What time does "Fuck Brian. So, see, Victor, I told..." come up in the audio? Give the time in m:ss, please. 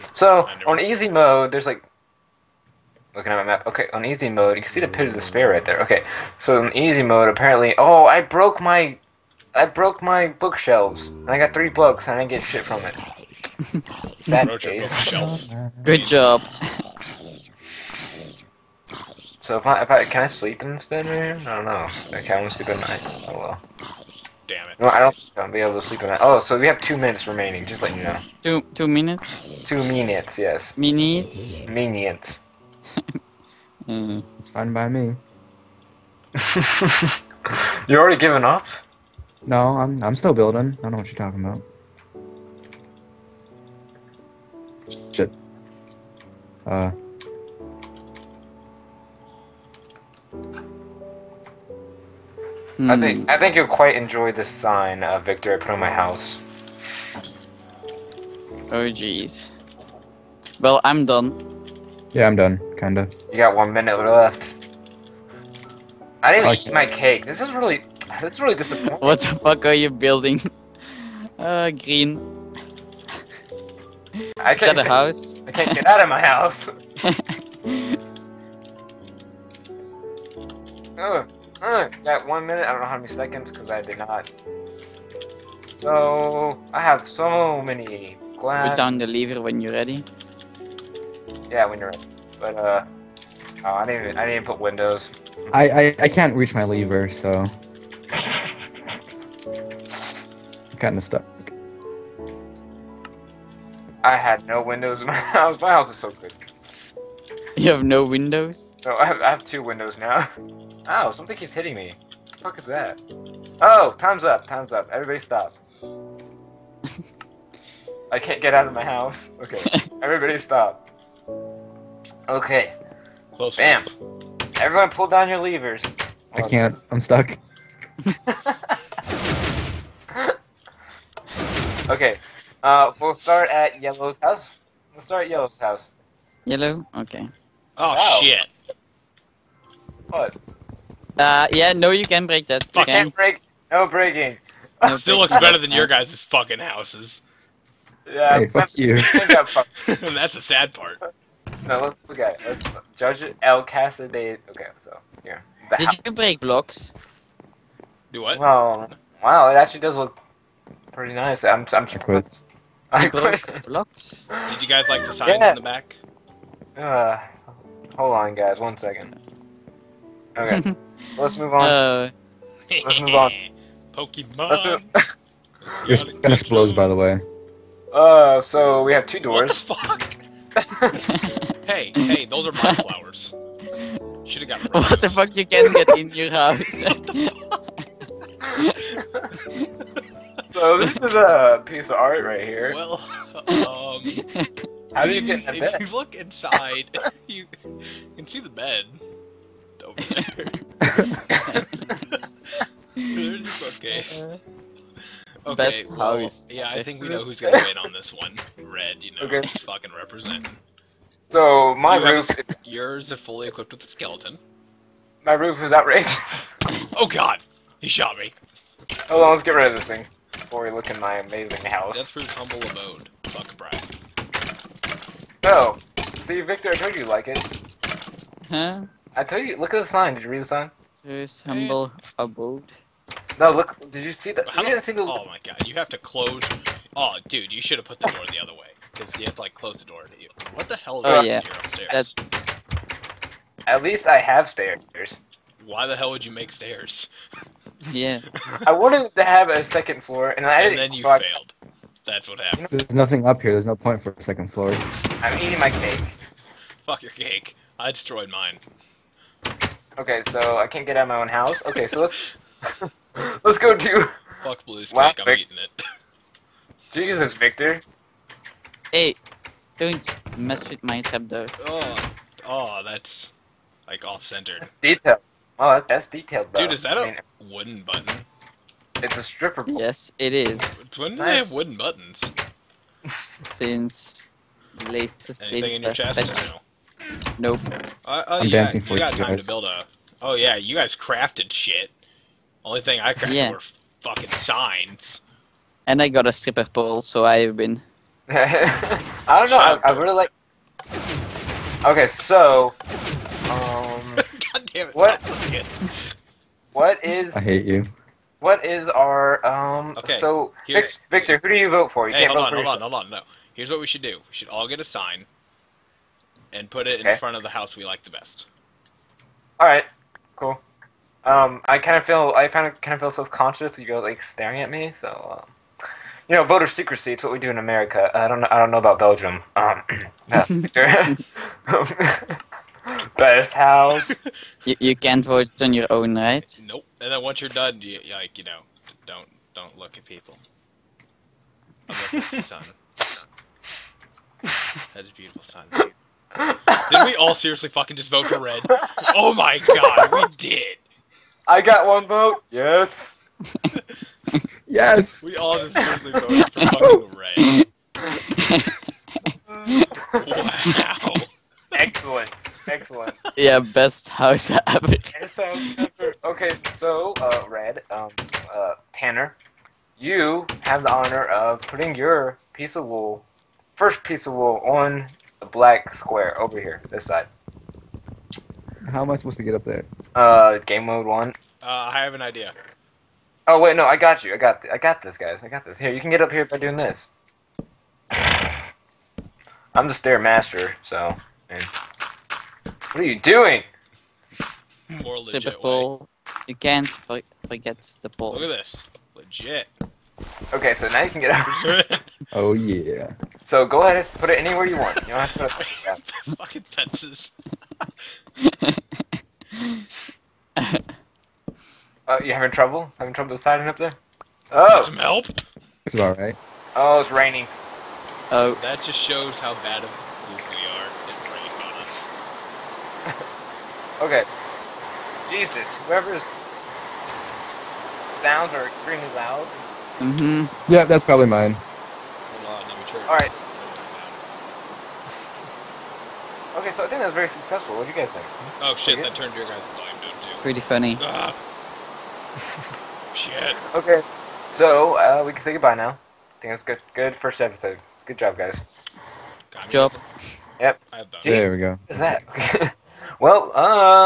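3:43.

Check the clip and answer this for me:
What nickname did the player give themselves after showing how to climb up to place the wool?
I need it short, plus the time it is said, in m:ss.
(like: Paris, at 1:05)
the stair master, at 6:29.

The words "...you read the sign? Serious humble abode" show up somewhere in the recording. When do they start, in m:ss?
3:50.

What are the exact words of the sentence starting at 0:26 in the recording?
Oh, so we have two minutes remaining.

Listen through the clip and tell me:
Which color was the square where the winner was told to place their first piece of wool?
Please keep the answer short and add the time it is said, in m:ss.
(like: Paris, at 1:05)
black, at 6:15.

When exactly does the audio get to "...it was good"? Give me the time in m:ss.
7:26.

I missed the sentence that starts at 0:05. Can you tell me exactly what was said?
Okay, so in easy mode, apparently.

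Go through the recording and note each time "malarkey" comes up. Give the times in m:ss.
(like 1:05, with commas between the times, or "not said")
not said.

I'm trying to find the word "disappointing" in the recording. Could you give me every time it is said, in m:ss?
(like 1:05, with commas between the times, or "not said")
1:08.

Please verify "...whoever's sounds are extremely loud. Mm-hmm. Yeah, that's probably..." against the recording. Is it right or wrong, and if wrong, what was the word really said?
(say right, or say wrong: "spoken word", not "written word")
right.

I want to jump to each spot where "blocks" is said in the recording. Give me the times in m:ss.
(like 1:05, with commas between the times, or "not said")
2:36, 2:43.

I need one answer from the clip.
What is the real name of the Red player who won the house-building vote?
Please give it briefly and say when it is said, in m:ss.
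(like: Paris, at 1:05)
Tanner, at 6:08.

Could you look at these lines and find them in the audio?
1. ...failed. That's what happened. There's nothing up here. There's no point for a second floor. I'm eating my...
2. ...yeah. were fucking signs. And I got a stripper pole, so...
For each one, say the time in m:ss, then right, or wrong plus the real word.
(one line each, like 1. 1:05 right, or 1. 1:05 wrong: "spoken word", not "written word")
1. 4:11 right
2. 4:53 right.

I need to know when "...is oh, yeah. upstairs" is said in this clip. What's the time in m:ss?
4:01.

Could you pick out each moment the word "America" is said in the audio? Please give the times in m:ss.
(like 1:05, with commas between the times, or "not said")
5:27.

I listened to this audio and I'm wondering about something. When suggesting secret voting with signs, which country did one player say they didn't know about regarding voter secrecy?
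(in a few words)
Belgium.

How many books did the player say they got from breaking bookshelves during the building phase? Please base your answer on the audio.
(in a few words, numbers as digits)
3.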